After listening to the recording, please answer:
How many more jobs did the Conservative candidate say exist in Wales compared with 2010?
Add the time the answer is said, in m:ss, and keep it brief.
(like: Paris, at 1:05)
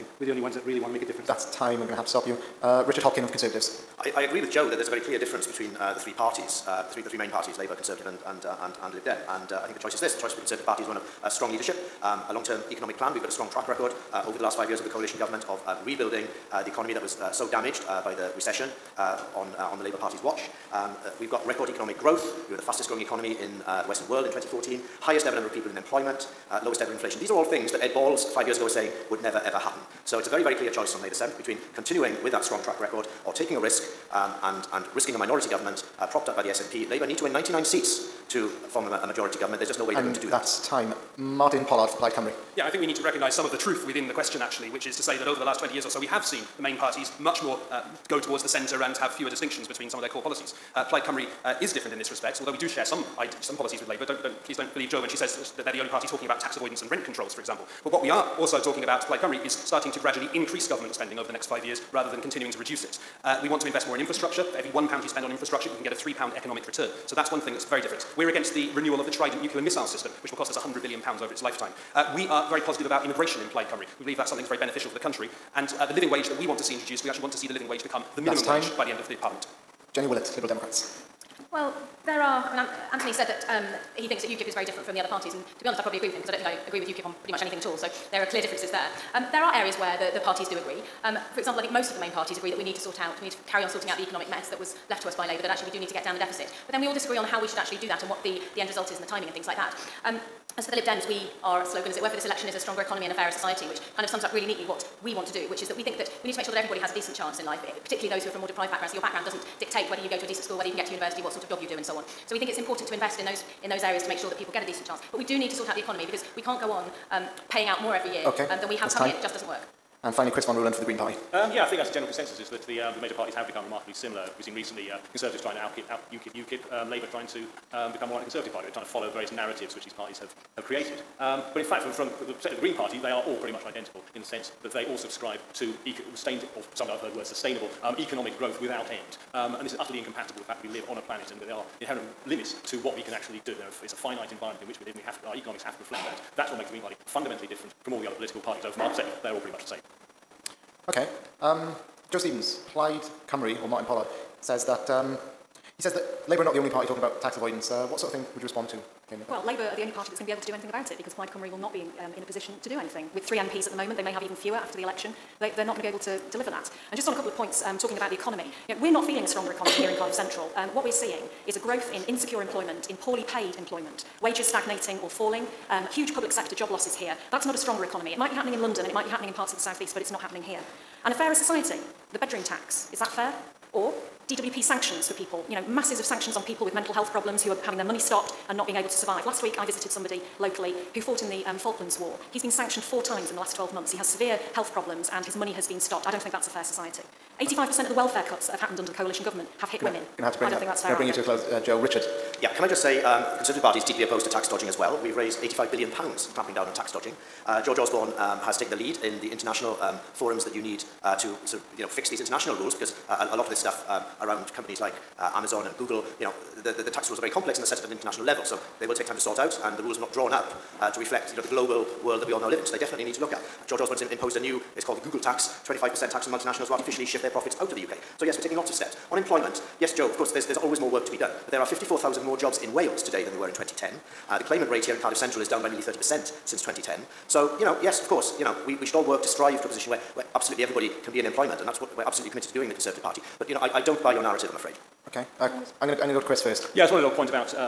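54,000, at 3:51.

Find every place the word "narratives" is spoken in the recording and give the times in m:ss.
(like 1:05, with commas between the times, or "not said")
2:09, 4:04.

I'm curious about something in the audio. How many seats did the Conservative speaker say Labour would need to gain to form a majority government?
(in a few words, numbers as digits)
99.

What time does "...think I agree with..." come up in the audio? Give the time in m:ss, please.
1:26.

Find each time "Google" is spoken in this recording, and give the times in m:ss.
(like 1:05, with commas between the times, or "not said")
3:35, 3:45.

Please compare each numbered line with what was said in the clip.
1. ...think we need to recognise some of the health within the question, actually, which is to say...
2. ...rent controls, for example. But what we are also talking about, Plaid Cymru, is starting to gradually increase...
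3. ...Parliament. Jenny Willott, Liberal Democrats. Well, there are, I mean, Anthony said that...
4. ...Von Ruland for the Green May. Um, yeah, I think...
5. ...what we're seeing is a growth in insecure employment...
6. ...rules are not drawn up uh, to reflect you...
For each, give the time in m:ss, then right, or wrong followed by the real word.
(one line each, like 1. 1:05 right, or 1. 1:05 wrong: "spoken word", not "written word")
1. 0:42 wrong: "truth", not "health"
2. 0:56 right
3. 1:19 right
4. 2:00 wrong: "Party", not "May"
5. 2:50 right
6. 3:39 right.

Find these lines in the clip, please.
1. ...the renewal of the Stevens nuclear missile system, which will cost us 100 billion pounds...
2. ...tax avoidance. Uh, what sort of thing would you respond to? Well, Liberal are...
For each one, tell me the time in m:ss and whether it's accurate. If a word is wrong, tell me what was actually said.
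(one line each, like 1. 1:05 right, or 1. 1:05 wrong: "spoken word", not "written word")
1. 1:08 wrong: "Trident", not "Stevens"
2. 2:37 wrong: "Labour", not "Liberal".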